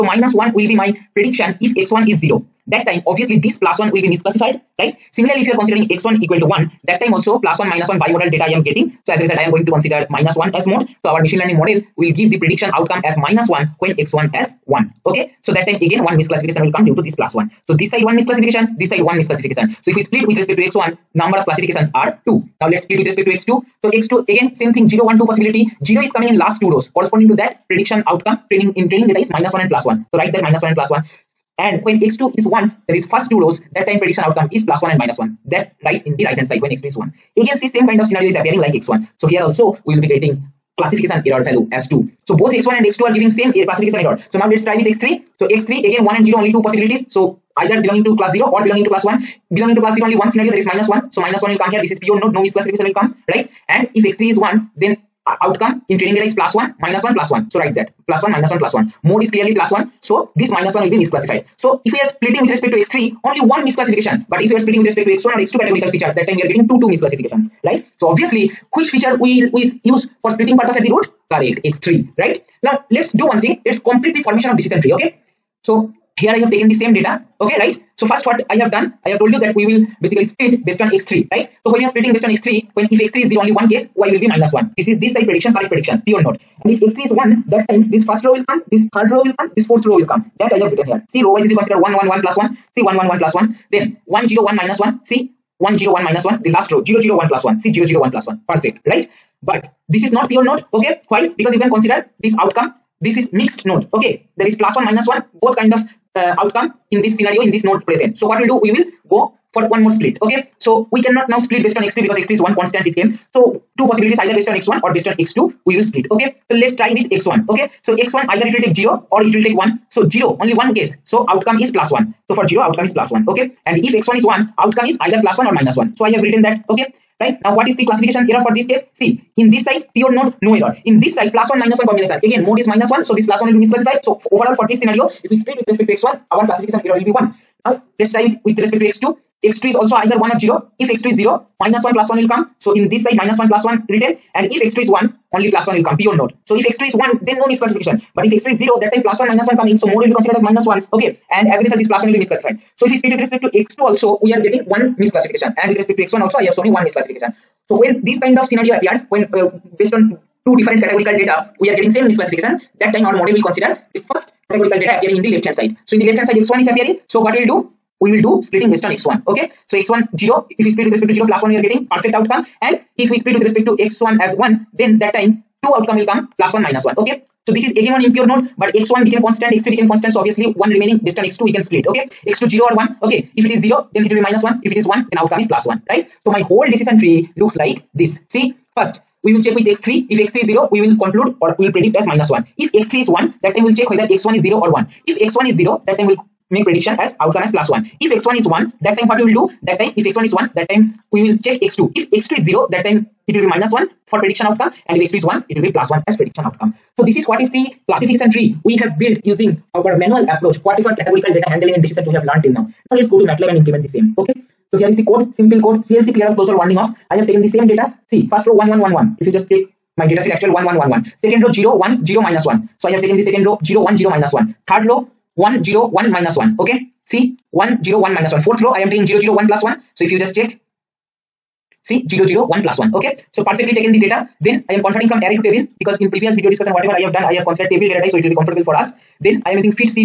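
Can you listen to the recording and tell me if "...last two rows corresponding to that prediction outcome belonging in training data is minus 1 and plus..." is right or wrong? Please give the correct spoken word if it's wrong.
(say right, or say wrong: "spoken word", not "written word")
wrong: "training", not "belonging".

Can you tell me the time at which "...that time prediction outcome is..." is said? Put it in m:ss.
0:33.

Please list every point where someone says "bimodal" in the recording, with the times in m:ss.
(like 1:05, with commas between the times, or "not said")
0:08.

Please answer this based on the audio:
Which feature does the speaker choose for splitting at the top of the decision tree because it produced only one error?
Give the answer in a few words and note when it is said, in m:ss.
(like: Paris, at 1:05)
x3, at 1:11.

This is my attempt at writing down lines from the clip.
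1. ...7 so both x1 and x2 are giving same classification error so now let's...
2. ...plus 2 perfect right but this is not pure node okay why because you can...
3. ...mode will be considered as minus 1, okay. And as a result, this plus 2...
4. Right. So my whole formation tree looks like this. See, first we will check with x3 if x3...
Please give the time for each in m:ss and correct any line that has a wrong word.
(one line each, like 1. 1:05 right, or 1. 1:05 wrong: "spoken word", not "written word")
1. 0:41 wrong: "2", not "7"
2. 1:38 wrong: "1", not "2"
3. 2:29 wrong: "1", not "2"
4. 3:05 wrong: "decision", not "formation".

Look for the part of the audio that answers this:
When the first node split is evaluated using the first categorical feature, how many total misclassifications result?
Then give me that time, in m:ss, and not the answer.
0:21.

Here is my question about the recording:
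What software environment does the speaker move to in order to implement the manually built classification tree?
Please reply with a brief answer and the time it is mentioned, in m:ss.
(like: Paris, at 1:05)
MATLAB, at 3:33.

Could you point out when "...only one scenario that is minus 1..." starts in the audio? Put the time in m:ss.
0:50.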